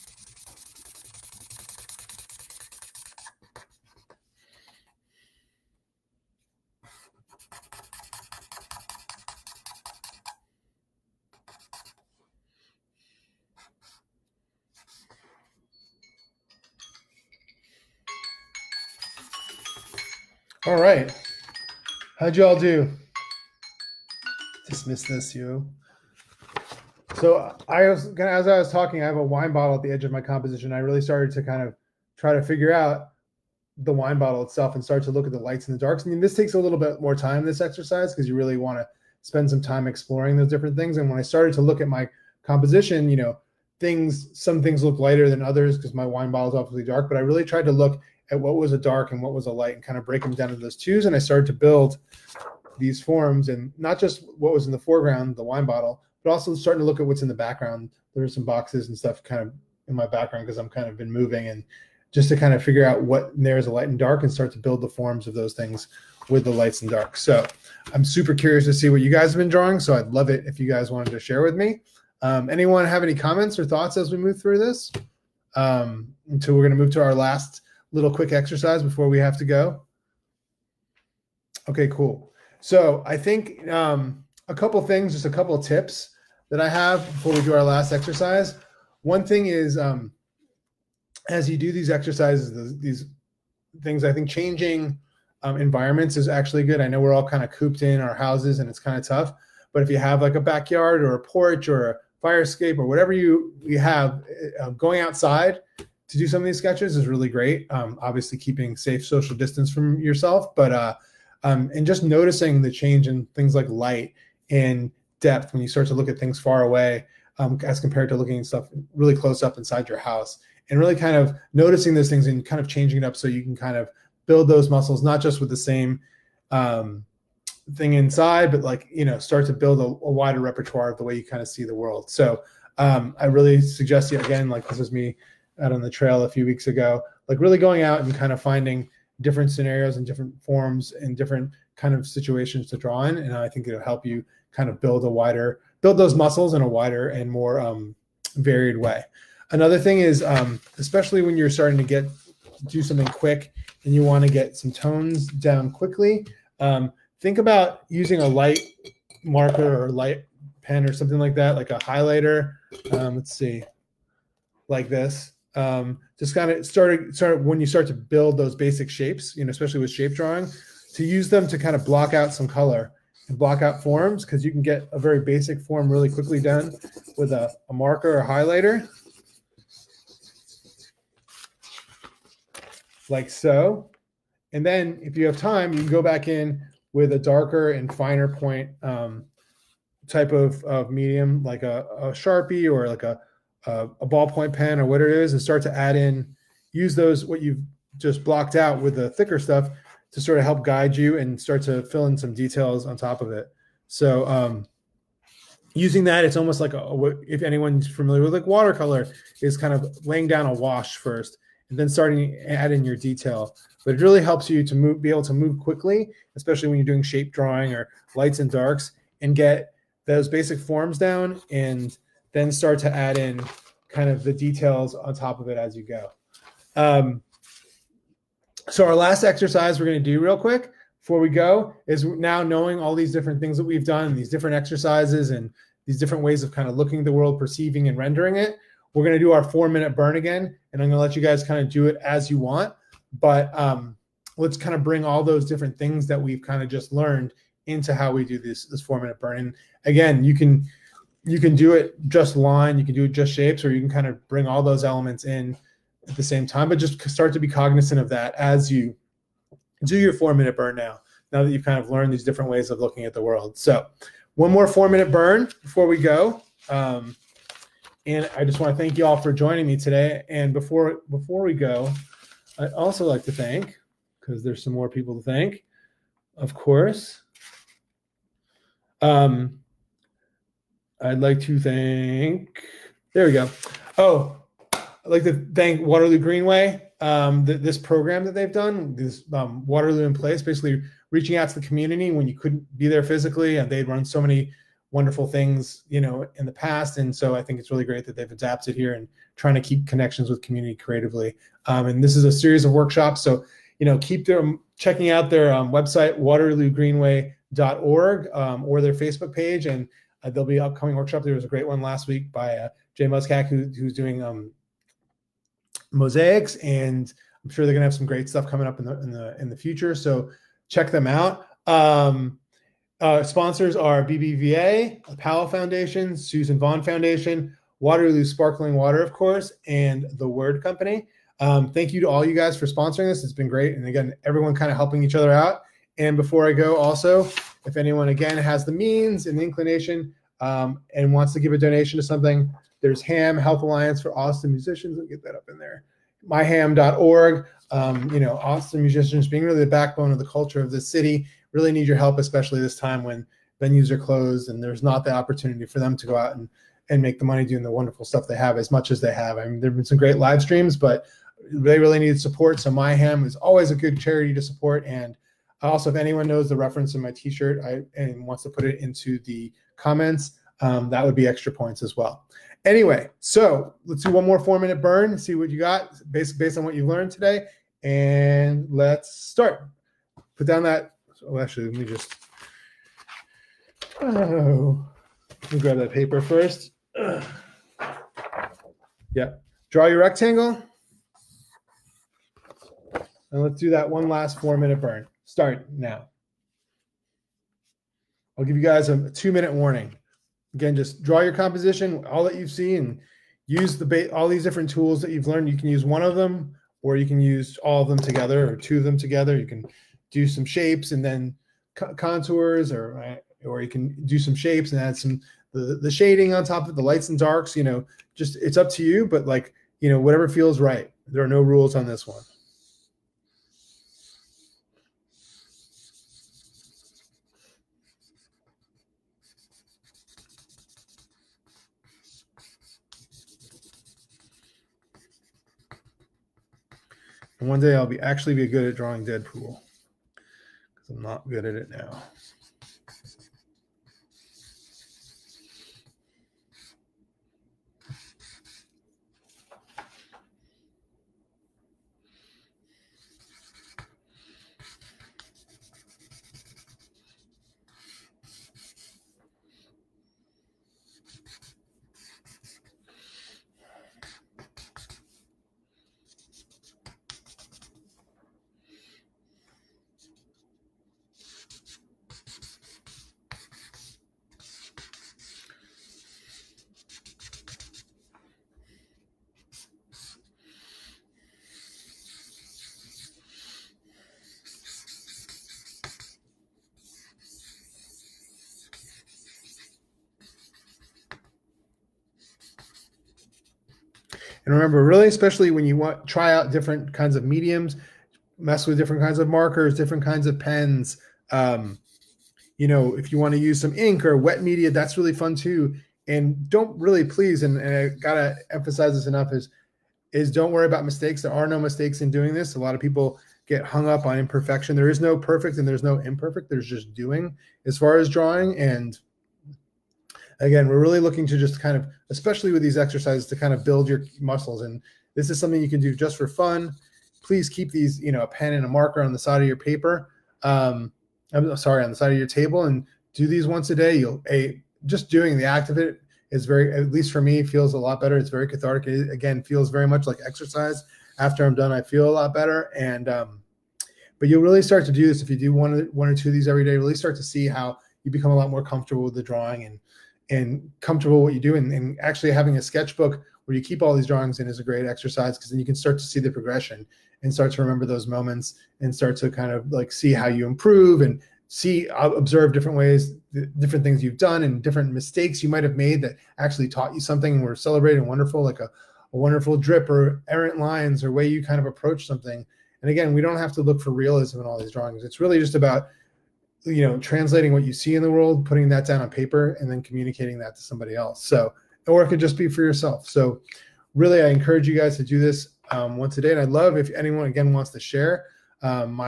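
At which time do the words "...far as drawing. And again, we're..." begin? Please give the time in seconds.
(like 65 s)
517 s.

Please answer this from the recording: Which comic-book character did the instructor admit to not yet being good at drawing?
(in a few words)
Deadpool.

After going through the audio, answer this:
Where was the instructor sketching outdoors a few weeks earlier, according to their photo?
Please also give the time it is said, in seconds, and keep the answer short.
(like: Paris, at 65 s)
on the trail, at 135 s.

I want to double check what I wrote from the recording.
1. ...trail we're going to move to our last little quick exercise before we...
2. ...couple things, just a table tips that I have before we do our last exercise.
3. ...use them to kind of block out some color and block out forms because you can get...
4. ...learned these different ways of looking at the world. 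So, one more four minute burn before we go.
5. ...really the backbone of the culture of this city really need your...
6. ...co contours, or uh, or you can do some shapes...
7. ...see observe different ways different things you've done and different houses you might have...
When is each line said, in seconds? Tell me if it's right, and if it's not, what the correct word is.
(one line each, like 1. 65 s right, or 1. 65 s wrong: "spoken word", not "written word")
1. 76 s wrong: "until", not "trail"
2. 84 s wrong: "couple", not "table"
3. 171 s right
4. 261 s right
5. 349 s right
6. 411 s right
7. 561 s wrong: "mistakes", not "houses".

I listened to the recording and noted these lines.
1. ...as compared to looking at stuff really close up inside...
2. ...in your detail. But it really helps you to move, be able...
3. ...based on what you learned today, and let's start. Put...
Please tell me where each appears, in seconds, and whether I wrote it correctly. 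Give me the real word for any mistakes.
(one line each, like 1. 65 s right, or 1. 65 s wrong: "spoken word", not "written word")
1. 117 s right
2. 212 s right
3. 376 s right.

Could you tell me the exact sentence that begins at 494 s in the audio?
but really, especially when you want try out different kinds of mediums, mess with different kinds of markers, different kinds of pens.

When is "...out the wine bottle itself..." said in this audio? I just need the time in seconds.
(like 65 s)
32 s.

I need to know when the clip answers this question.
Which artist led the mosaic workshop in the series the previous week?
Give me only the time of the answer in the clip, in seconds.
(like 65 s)
312 s.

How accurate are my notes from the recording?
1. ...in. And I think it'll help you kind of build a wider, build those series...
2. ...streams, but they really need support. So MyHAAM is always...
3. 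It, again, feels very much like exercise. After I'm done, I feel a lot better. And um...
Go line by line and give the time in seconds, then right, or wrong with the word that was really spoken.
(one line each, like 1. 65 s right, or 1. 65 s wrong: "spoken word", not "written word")
1. 143 s wrong: "muscles", not "series"
2. 360 s right
3. 538 s right.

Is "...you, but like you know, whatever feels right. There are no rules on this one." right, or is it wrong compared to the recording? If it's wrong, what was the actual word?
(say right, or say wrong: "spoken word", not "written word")
right.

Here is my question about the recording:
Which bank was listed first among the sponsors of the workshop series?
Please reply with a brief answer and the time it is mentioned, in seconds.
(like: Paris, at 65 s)
BBVA, at 324 s.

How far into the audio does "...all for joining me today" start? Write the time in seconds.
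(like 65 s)
269 s.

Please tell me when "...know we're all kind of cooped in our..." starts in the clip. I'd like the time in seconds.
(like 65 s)
96 s.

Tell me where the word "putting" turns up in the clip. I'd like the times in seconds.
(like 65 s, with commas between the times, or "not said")
578 s.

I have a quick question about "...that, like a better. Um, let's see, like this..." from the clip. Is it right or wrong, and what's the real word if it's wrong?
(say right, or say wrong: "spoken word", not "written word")
wrong: "highlighter", not "better".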